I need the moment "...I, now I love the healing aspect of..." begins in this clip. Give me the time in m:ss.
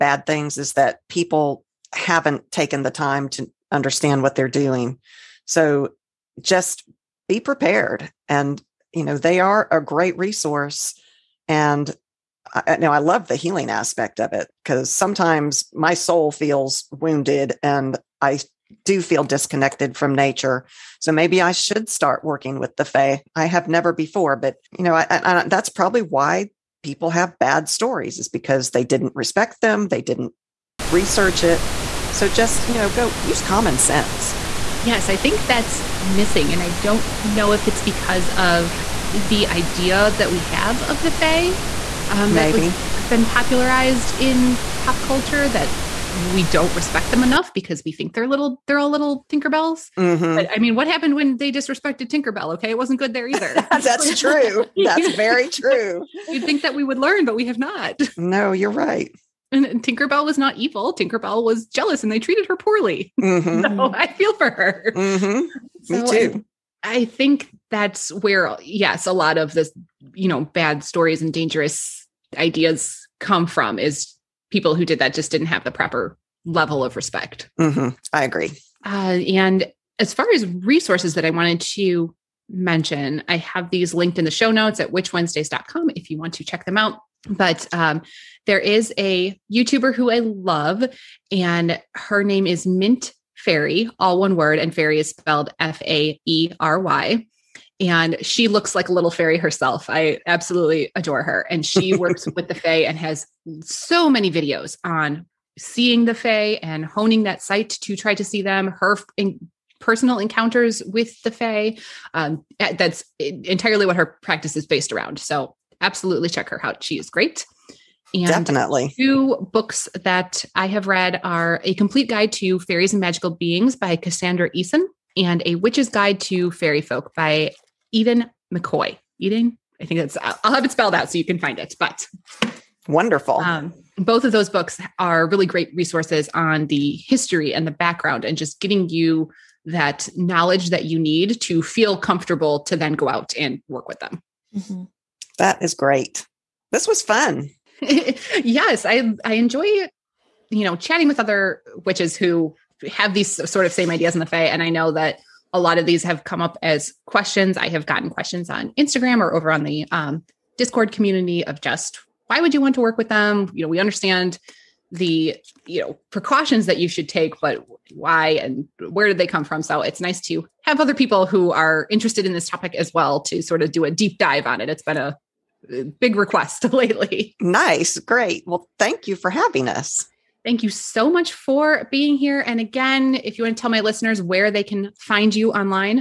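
0:12.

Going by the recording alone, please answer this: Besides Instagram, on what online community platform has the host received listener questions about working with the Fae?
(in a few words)
Discord.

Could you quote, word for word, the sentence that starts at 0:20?
So maybe I should start working with the Fae.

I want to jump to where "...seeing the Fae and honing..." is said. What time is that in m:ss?
1:45.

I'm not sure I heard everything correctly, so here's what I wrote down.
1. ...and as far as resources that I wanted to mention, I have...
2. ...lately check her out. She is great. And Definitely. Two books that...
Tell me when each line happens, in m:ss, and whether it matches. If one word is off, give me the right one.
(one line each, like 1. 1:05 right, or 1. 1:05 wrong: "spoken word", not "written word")
1. 1:19 right
2. 1:55 wrong: "absolutely", not "lately".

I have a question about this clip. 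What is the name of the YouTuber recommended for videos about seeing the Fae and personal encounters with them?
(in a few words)
Mint Faery.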